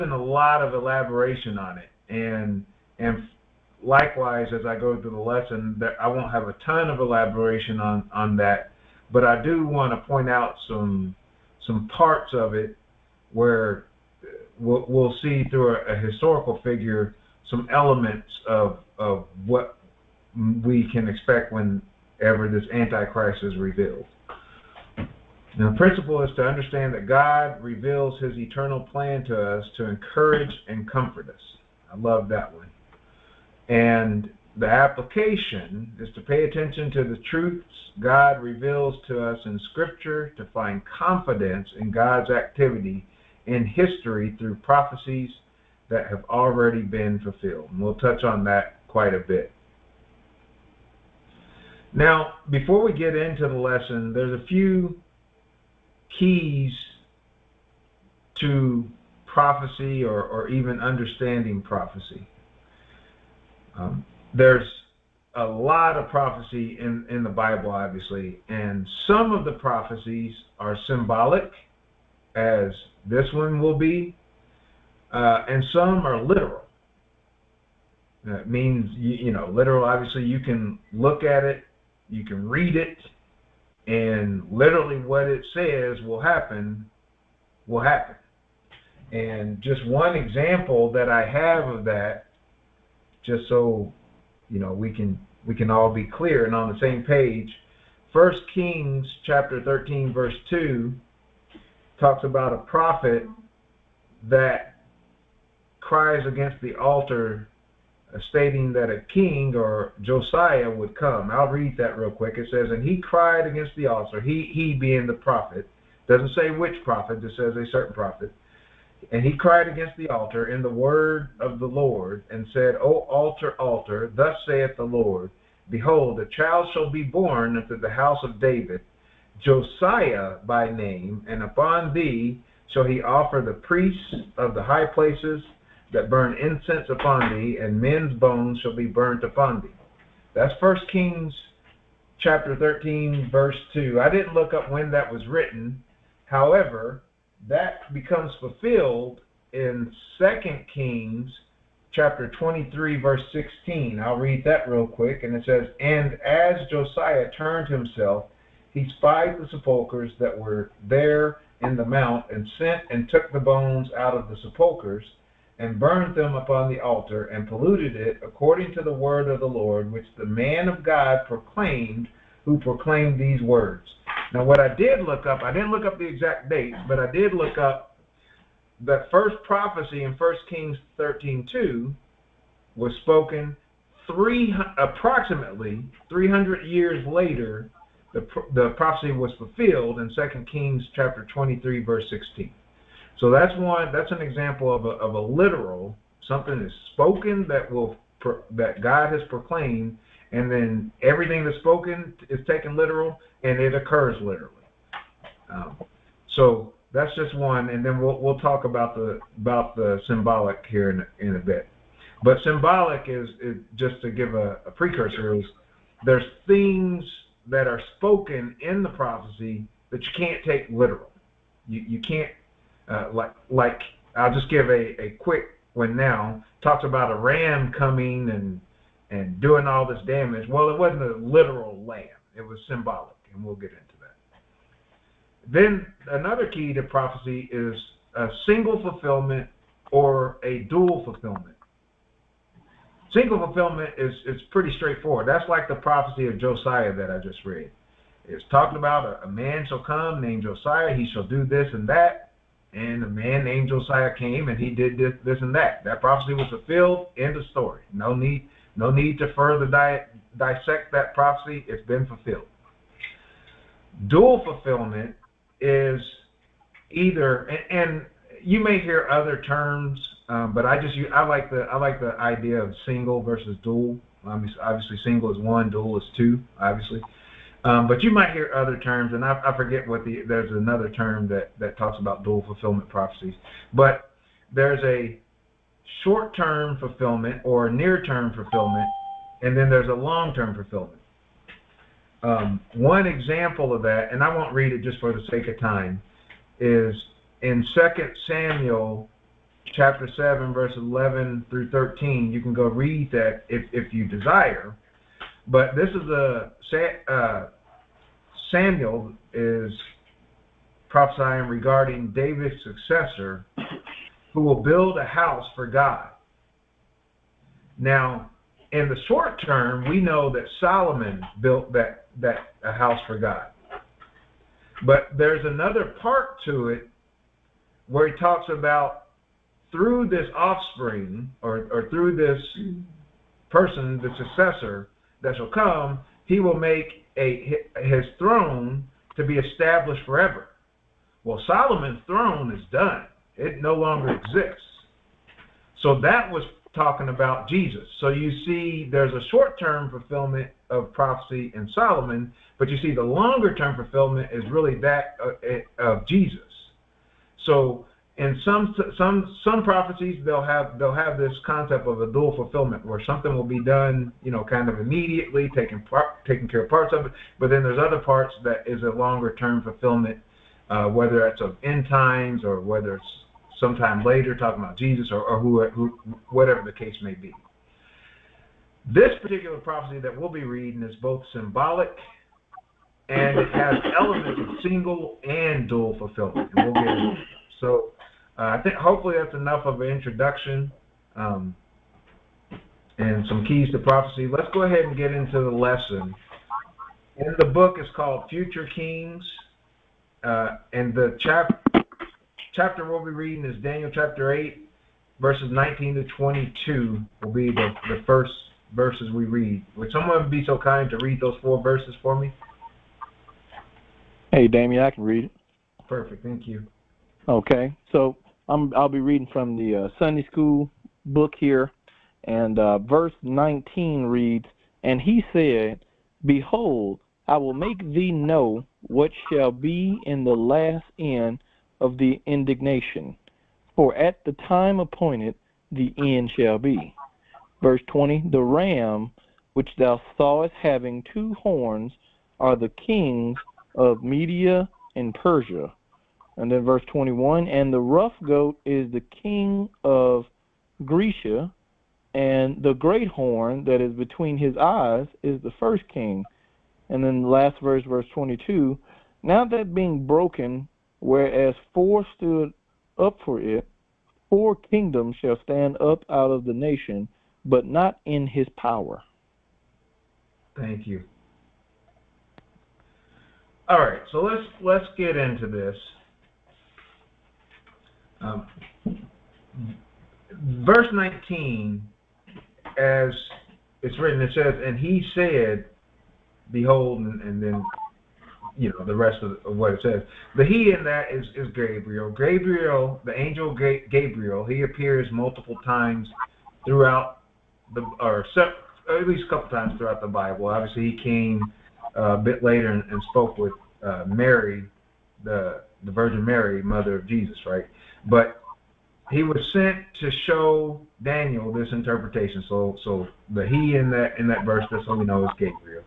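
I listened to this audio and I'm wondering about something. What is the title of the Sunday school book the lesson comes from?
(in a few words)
Future Kings.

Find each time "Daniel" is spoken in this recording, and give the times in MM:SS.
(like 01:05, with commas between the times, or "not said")
06:43, 08:31.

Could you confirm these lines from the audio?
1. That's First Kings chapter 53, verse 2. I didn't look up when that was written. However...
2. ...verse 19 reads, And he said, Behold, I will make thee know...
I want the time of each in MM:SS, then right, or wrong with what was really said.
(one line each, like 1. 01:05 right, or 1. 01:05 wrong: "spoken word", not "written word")
1. 02:20 wrong: "13", not "53"
2. 07:02 right.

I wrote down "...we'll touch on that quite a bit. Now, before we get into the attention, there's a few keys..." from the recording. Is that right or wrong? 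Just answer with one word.
wrong.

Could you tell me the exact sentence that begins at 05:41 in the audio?
Well, Solomon's throne is done, it no longer exists.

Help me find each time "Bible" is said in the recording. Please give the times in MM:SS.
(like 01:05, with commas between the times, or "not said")
01:07, 08:20.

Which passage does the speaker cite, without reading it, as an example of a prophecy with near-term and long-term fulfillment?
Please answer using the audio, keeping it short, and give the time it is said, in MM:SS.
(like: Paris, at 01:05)
2 Samuel 7:11-13, at 04:57.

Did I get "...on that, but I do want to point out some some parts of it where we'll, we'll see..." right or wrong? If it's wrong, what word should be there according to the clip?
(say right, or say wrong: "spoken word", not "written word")
right.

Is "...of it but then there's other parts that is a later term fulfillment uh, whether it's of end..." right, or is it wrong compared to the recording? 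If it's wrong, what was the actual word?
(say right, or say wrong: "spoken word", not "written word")
wrong: "longer", not "later".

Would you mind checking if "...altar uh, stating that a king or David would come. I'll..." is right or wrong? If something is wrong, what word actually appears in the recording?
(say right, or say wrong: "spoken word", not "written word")
wrong: "Josiah", not "David".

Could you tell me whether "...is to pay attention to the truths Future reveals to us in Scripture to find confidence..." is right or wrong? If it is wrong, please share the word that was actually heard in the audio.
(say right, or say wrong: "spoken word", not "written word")
wrong: "God", not "Future".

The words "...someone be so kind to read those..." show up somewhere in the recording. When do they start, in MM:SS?
06:49.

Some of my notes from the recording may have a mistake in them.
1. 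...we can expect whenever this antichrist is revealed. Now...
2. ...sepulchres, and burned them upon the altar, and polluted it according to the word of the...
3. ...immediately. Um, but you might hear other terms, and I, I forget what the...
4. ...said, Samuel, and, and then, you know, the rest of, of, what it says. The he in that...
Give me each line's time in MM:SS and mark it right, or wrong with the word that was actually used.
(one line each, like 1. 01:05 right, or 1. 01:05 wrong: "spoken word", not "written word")
1. 00:20 right
2. 02:44 right
3. 04:36 wrong: "obviously", not "immediately"
4. 08:05 wrong: "Behold", not "Samuel".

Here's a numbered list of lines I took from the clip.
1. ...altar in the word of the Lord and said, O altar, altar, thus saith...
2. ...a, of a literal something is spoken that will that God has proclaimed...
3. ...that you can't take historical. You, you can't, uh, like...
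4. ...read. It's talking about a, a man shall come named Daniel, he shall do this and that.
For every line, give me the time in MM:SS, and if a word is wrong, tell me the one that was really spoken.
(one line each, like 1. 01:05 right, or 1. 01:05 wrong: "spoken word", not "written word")
1. 02:00 right
2. 03:14 right
3. 03:39 wrong: "literal", not "historical"
4. 04:07 wrong: "Josiah", not "Daniel".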